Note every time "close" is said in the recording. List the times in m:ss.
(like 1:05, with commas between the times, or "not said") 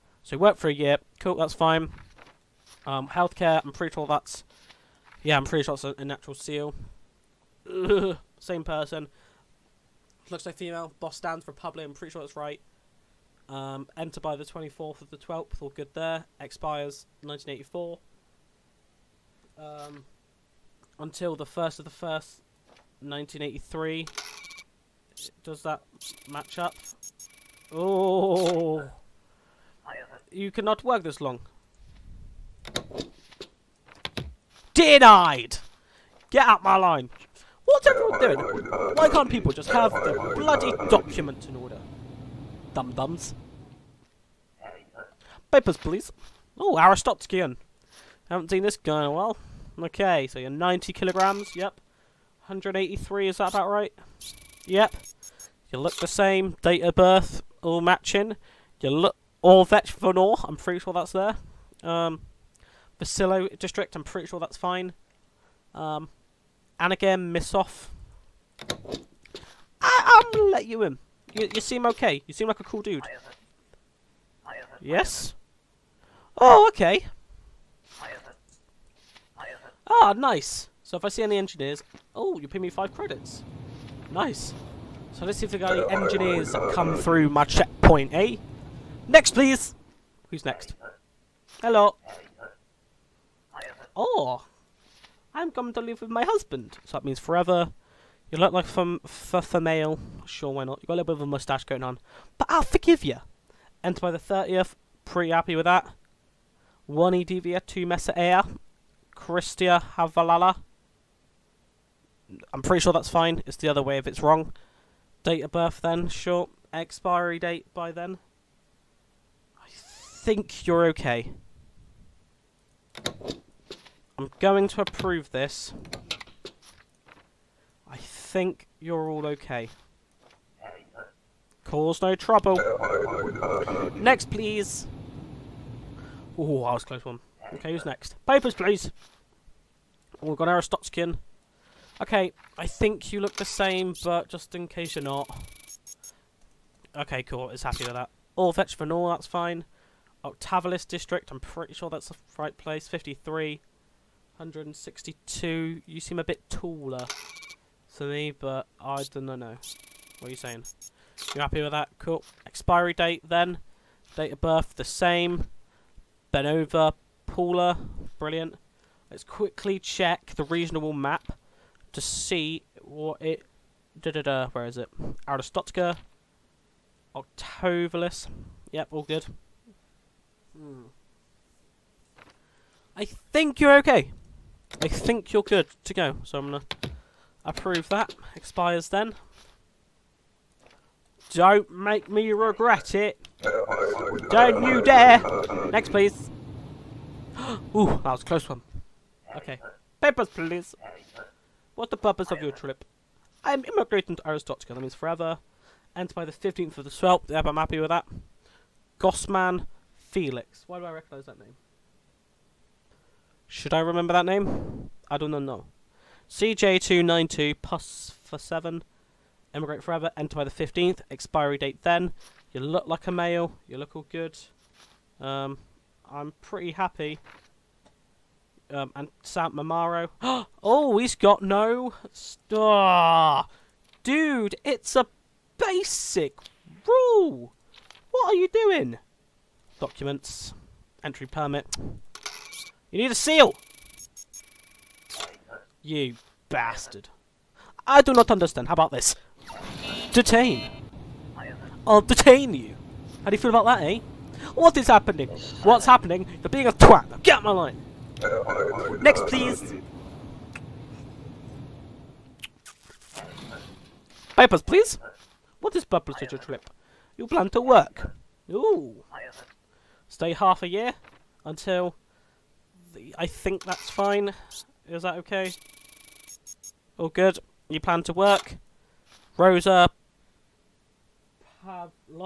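2:16, 3:18.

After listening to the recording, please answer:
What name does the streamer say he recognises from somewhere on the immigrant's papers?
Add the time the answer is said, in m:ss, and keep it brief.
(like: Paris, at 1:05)
Gossman Felix, at 3:28.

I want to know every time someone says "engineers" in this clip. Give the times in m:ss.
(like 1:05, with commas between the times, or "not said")
1:21, 1:25.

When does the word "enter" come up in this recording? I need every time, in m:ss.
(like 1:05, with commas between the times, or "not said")
0:13, 1:43, 3:25, 3:40.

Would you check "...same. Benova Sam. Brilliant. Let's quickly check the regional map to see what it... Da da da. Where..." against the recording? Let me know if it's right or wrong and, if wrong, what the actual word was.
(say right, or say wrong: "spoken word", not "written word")
wrong: "Paula", not "Sam".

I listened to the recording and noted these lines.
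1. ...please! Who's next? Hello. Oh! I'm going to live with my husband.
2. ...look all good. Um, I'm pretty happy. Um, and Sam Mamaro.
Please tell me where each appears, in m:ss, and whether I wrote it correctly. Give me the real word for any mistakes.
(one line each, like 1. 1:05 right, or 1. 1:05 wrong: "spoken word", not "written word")
1. 1:29 right
2. 3:43 right.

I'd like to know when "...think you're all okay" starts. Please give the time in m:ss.
2:07.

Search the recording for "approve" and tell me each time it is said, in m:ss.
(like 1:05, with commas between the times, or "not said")
2:04, 3:07.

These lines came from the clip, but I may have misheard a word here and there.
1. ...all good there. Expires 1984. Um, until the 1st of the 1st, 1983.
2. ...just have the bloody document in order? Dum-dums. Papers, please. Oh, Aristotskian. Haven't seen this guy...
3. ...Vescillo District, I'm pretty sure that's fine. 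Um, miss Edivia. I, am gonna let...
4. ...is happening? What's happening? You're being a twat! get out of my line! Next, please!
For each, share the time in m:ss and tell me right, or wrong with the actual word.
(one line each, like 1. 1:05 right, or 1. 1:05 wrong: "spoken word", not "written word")
1. 0:15 right
2. 0:39 right
3. 1:02 wrong: "Misoff", not "Edivia"
4. 4:14 right.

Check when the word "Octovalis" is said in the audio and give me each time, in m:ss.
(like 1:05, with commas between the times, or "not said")
2:30, 2:57.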